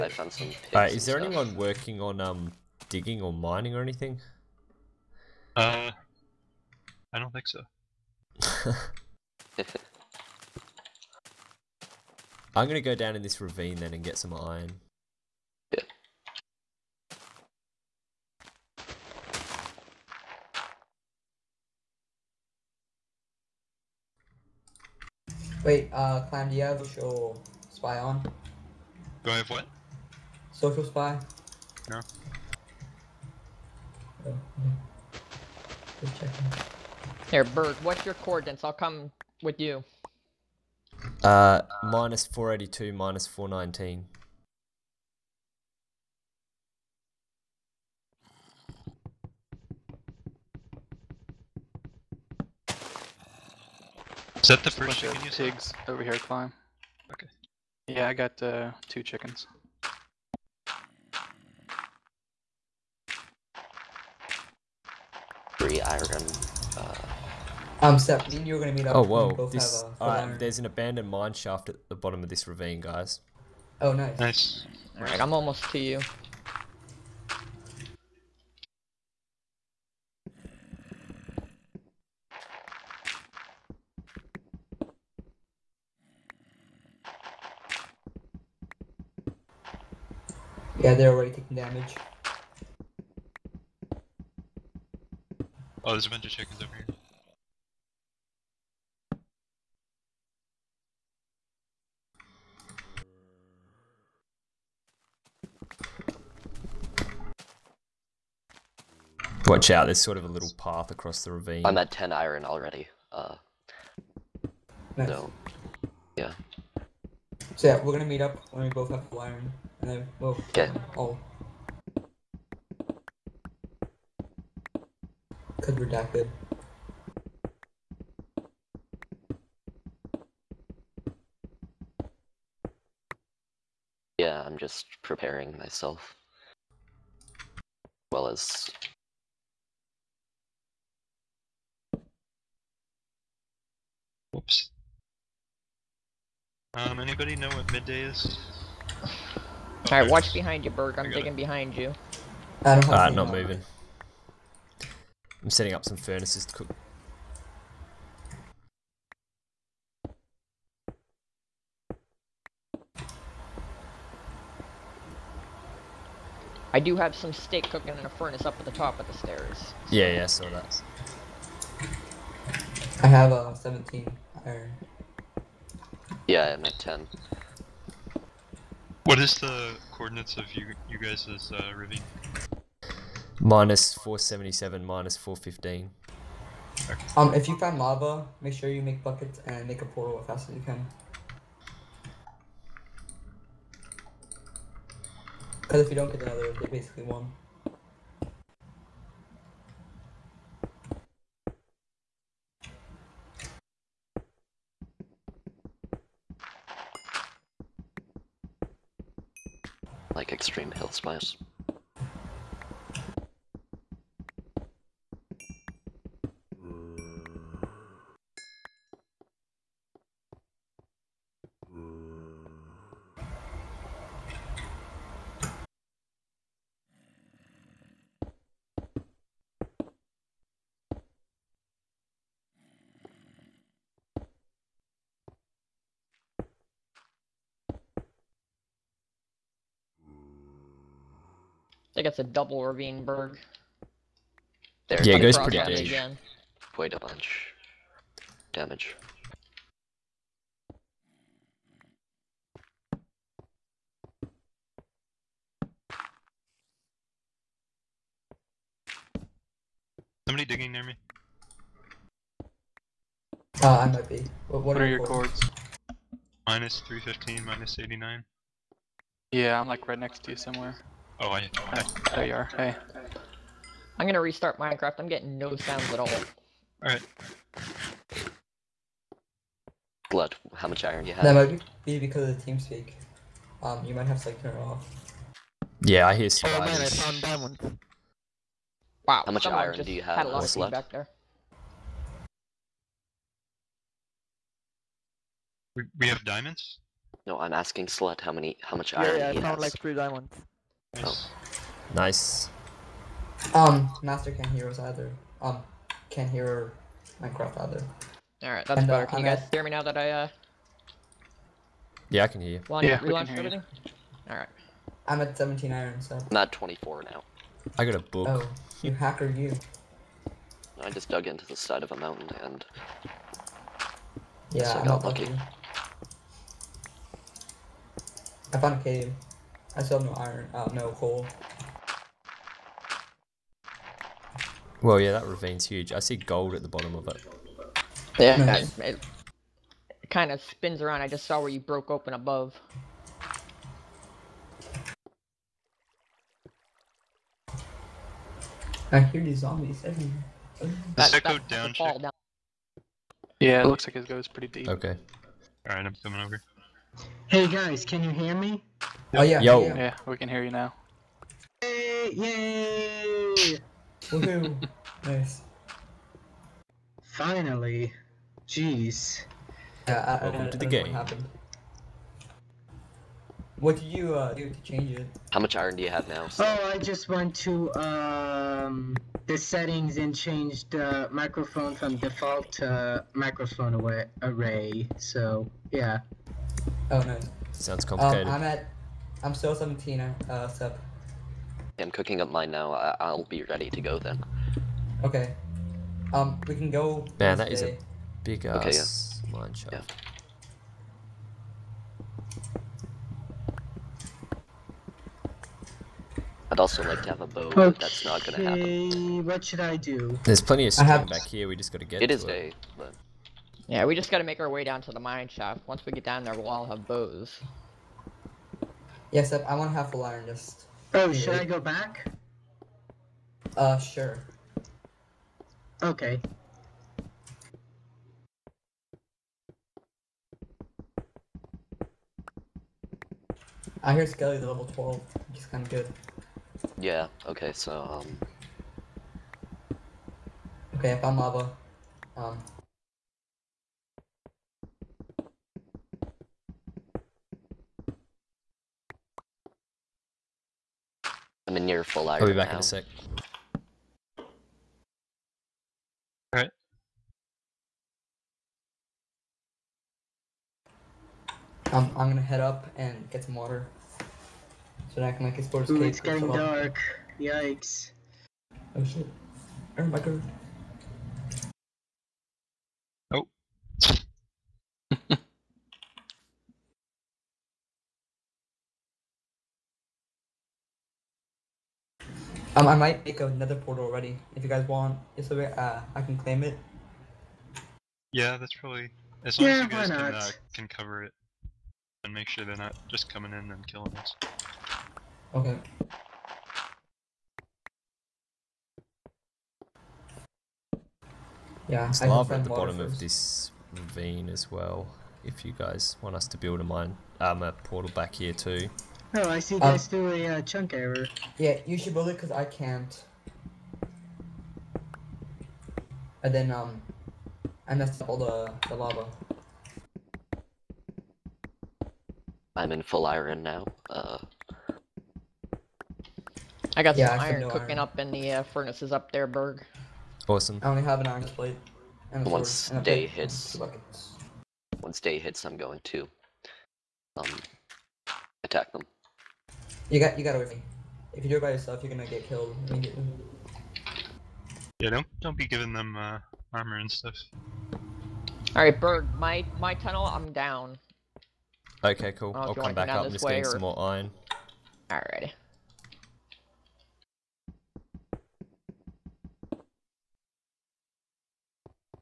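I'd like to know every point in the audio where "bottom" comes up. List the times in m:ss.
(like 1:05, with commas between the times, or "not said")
1:11, 5:36, 8:22.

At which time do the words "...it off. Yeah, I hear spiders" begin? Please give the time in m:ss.
4:44.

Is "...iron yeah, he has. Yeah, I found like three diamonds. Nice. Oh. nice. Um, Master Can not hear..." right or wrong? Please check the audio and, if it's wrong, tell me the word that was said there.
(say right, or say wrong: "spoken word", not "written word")
right.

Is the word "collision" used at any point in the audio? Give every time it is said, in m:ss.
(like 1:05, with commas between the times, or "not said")
not said.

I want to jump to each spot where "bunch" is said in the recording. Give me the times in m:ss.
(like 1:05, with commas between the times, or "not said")
1:36, 4:06.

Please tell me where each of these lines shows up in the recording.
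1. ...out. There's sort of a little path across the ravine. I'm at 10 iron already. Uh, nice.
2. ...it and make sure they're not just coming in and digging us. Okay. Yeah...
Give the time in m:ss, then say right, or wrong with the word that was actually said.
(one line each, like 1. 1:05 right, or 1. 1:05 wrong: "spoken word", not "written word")
1. 1:49 right
2. 8:11 wrong: "killing", not "digging".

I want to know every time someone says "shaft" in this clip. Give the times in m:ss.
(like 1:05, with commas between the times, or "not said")
1:11, 6:55.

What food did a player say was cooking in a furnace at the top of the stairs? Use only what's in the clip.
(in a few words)
steak.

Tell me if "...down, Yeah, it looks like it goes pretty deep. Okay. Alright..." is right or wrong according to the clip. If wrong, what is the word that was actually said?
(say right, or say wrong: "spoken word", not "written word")
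right.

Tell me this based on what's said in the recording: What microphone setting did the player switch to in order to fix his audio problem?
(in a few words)
microphone array.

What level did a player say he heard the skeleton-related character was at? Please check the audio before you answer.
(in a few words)
12.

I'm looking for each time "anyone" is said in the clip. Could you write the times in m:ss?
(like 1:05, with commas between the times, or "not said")
0:01.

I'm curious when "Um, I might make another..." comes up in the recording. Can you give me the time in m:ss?
8:02.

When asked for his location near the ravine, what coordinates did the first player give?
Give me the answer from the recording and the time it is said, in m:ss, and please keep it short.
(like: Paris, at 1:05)
-482, -419, at 0:41.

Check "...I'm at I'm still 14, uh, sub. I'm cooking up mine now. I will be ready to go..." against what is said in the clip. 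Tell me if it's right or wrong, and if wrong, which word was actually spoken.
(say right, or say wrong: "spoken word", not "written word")
wrong: "17", not "14".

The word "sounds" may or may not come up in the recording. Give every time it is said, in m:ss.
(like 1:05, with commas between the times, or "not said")
4:35, 6:27.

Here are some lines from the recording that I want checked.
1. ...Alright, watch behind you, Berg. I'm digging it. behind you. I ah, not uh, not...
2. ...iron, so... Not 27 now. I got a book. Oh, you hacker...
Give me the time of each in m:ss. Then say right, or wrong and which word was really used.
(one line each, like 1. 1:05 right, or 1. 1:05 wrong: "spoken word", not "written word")
1. 2:29 right
2. 5:15 wrong: "24", not "27".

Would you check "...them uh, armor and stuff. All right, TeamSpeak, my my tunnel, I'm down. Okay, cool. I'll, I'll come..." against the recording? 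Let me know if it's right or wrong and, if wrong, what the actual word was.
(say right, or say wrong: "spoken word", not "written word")
wrong: "Berg", not "TeamSpeak".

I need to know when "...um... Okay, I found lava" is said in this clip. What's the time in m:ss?
7:18.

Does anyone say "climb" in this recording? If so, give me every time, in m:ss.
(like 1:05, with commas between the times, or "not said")
0:26, 0:56.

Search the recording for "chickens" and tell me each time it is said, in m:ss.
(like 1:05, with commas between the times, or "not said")
0:54, 0:59, 1:36.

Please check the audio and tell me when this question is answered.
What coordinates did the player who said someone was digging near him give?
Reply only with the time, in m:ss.
4:26.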